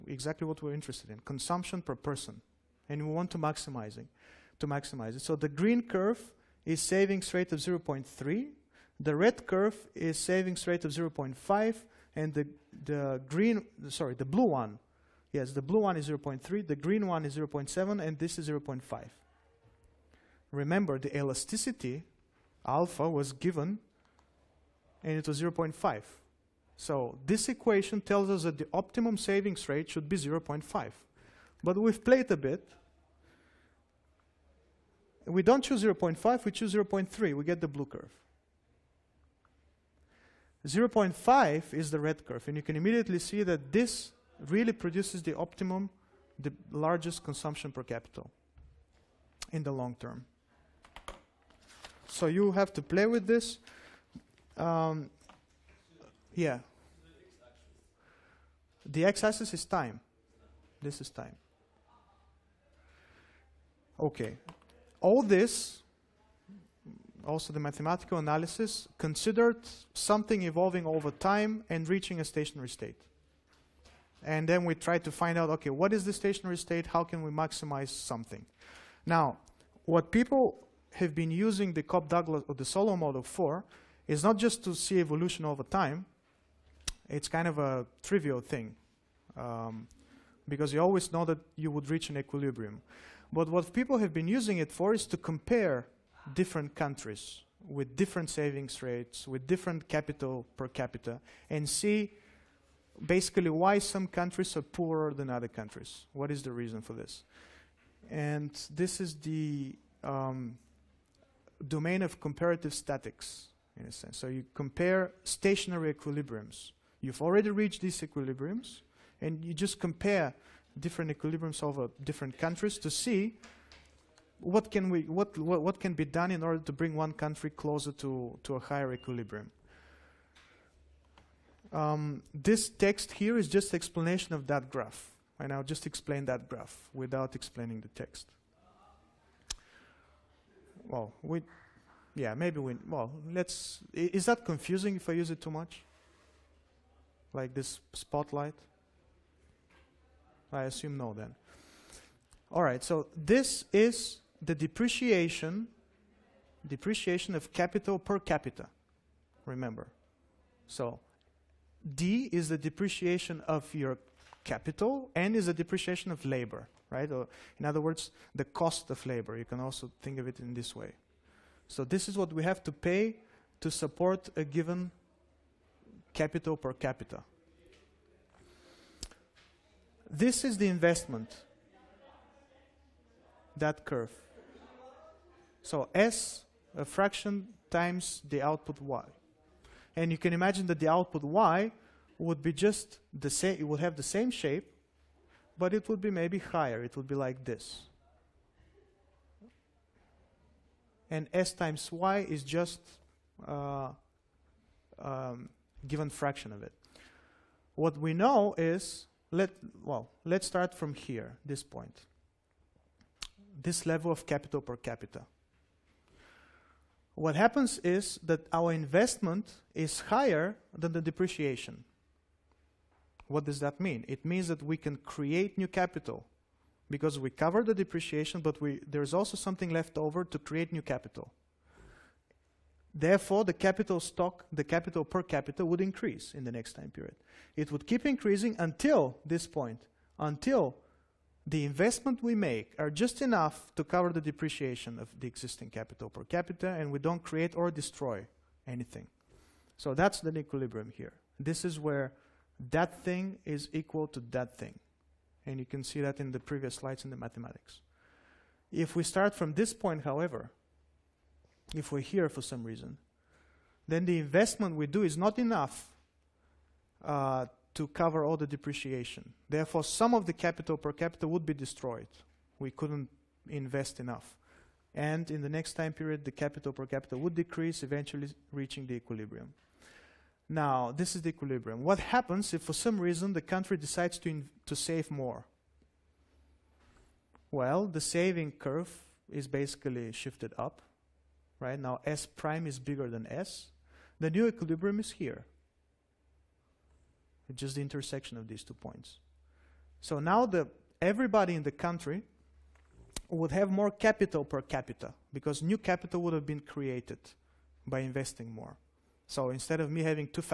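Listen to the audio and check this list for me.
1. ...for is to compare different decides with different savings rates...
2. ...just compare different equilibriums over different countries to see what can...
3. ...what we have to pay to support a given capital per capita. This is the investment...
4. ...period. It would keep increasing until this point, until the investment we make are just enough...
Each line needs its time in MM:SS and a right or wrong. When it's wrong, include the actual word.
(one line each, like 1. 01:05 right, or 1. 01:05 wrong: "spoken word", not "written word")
1. 01:34 wrong: "countries", not "decides"
2. 01:59 right
3. 02:52 right
4. 03:56 right.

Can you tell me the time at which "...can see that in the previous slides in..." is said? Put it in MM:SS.
04:15.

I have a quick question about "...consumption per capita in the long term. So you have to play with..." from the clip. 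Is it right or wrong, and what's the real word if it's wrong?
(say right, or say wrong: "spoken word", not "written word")
right.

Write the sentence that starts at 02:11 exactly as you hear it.
Um, this text here is just explanation of that graph.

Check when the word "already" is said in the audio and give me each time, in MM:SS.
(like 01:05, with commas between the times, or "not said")
01:57.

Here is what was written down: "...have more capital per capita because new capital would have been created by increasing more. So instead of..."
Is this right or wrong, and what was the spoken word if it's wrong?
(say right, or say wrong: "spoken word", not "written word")
wrong: "investing", not "increasing".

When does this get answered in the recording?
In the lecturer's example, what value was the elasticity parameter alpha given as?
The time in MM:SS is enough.
00:25.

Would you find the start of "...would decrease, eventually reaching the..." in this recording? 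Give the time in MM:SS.
04:37.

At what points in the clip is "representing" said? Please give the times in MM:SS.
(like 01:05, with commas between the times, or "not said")
not said.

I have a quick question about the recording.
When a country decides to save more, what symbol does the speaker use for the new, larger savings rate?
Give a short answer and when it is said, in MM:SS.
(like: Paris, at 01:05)
S prime, at 04:52.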